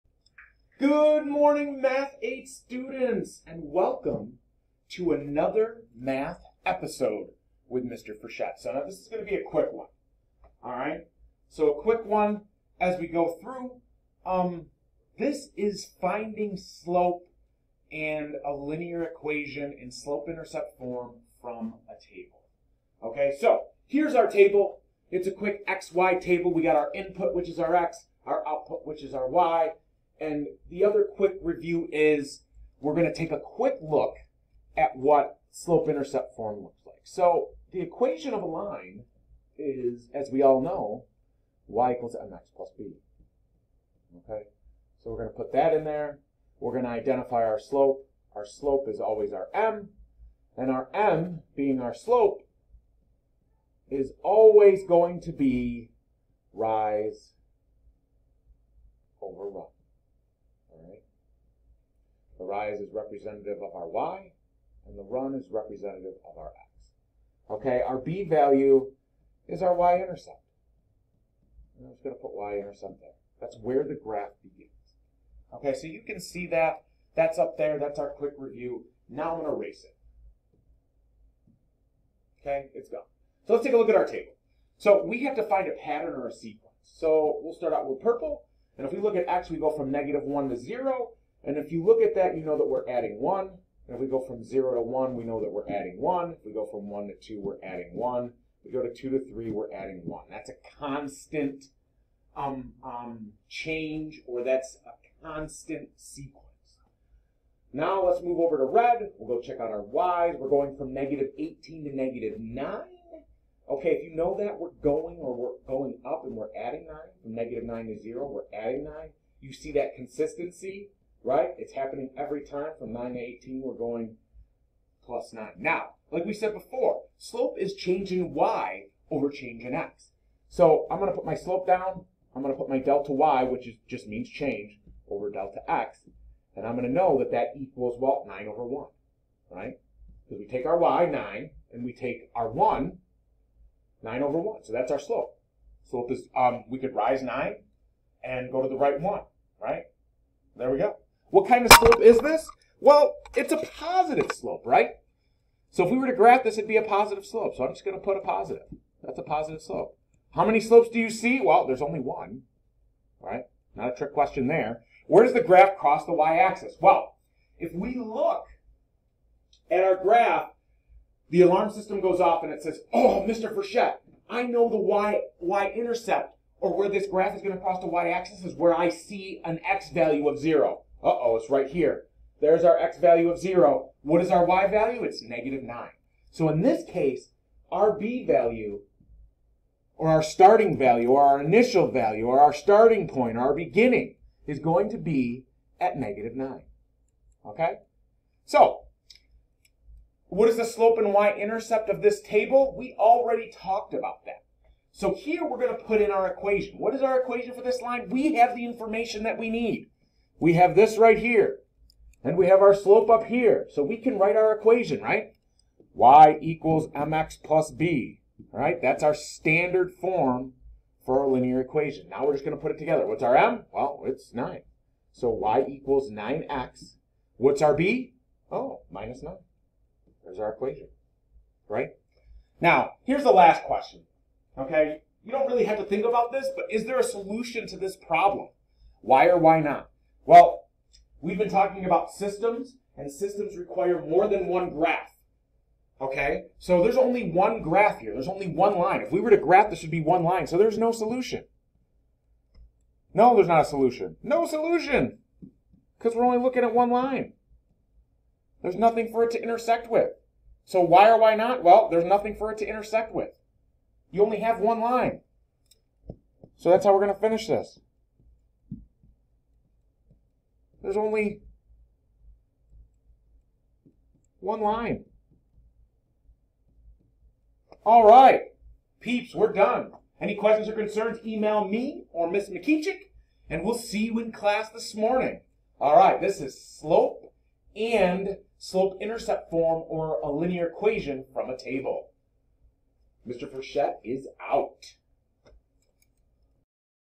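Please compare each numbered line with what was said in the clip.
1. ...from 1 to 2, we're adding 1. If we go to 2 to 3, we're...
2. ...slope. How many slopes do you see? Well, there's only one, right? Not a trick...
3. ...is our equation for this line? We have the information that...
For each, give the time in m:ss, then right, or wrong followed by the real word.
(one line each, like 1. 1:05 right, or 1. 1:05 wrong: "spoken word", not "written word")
1. 1:36 right
2. 2:39 right
3. 3:26 right.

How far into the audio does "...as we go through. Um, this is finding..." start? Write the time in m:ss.
0:12.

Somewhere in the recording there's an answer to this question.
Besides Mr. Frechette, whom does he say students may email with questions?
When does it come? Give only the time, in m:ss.
4:42.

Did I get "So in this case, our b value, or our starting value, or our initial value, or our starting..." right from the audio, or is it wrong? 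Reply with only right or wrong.
right.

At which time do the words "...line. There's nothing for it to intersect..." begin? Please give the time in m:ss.
4:16.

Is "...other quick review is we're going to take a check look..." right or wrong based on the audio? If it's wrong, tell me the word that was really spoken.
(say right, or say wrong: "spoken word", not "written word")
wrong: "quick", not "check".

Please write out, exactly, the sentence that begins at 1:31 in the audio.
And if you look at that, you know that we're adding 1.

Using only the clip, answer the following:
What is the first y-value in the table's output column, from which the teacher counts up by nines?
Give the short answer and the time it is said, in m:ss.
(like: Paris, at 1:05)
-18, at 1:50.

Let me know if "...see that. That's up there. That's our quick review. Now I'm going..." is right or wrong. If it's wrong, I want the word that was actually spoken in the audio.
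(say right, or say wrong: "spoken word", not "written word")
right.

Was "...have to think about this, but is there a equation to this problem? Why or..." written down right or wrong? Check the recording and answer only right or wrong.
wrong.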